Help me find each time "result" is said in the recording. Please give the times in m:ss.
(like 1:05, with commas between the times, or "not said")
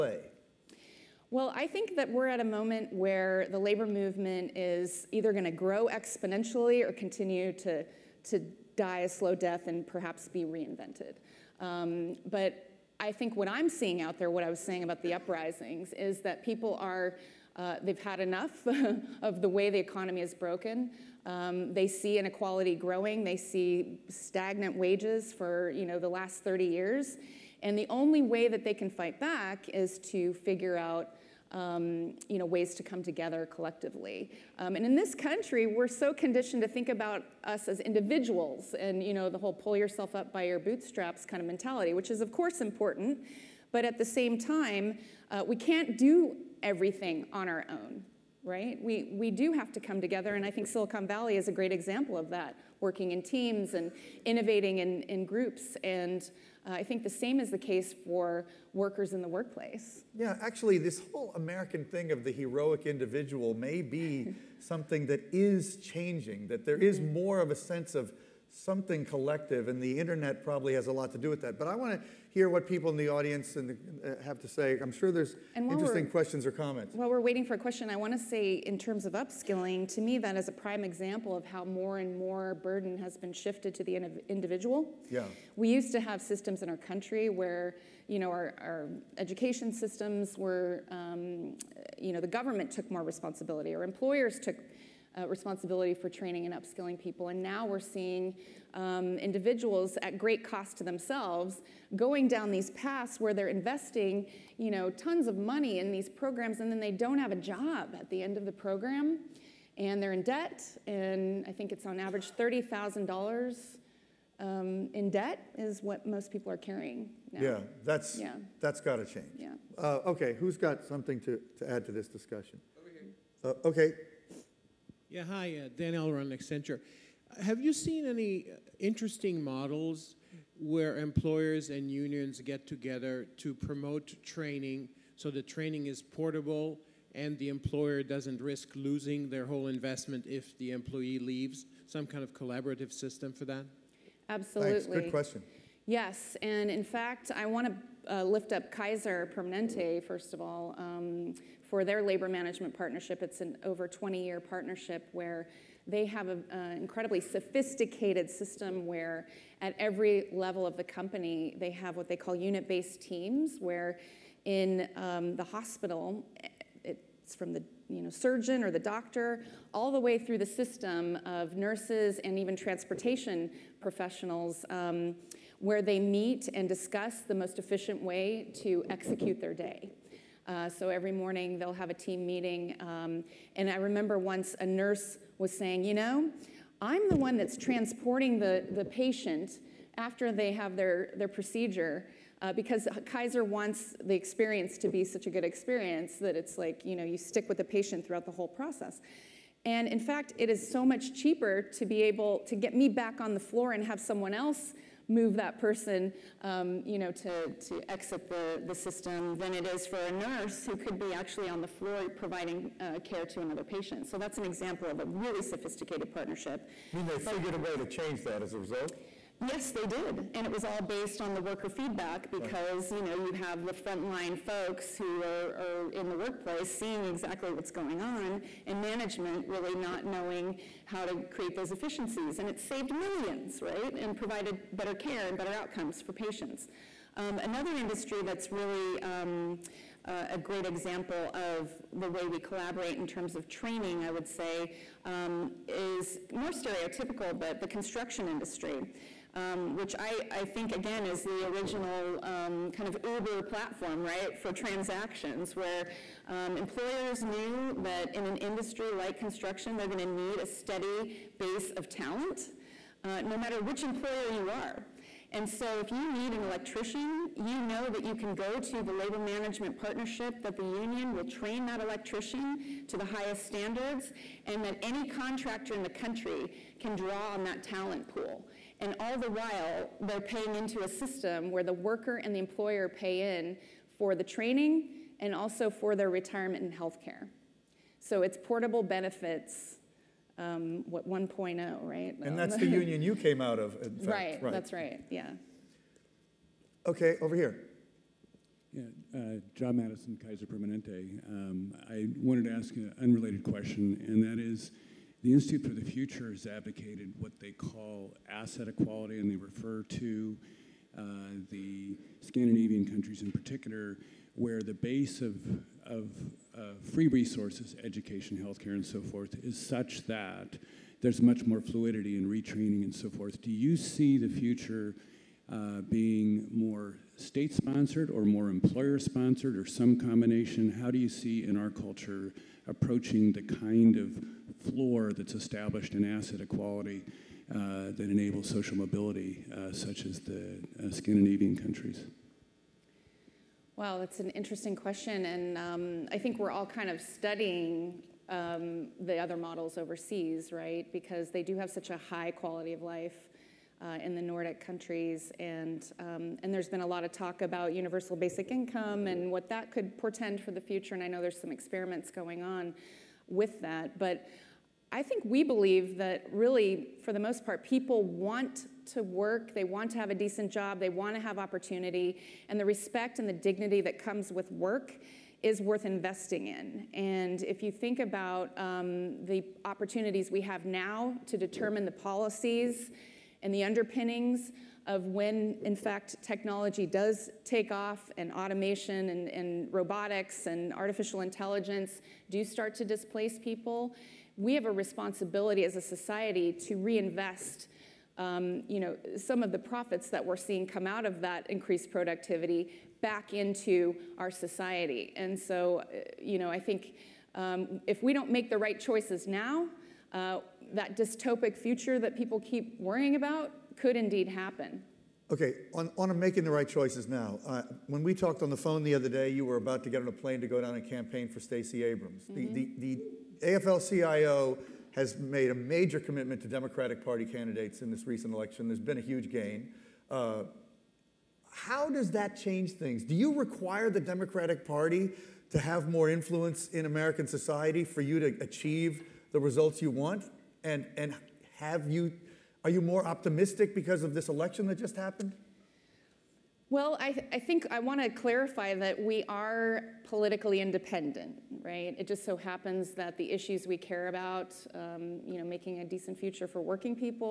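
3:38, 7:19.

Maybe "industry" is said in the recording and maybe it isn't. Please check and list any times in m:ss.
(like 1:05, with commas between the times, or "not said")
3:57, 4:08, 4:18.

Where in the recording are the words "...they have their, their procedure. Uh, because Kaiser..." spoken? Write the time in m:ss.
3:10.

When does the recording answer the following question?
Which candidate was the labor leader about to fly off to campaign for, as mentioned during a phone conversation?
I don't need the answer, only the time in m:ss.
7:01.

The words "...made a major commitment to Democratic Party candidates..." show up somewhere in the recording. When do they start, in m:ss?
7:05.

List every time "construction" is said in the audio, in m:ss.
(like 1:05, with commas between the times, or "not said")
4:07, 4:19.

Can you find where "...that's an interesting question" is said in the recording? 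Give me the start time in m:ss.
5:43.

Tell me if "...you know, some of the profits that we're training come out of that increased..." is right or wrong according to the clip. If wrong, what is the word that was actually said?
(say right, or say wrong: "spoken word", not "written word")
wrong: "seeing", not "training".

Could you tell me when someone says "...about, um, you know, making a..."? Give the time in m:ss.
7:34.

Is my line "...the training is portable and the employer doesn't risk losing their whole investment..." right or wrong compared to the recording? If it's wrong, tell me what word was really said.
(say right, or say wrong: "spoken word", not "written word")
right.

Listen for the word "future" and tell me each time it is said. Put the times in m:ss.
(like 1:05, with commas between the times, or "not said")
5:05, 5:24, 6:00, 6:51, 7:36.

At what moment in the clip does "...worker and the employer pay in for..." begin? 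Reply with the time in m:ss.
4:41.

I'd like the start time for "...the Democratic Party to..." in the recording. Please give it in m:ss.
7:13.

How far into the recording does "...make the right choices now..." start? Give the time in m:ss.
6:48.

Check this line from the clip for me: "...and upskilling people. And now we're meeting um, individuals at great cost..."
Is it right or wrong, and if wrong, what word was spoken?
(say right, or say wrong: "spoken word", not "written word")
wrong: "seeing", not "meeting".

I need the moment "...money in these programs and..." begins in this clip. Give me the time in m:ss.
1:45.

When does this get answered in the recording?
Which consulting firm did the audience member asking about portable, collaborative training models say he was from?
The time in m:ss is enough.
2:06.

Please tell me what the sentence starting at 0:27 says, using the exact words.
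And the only way that they can fight back is to figure out um, you know, ways to come together collectively.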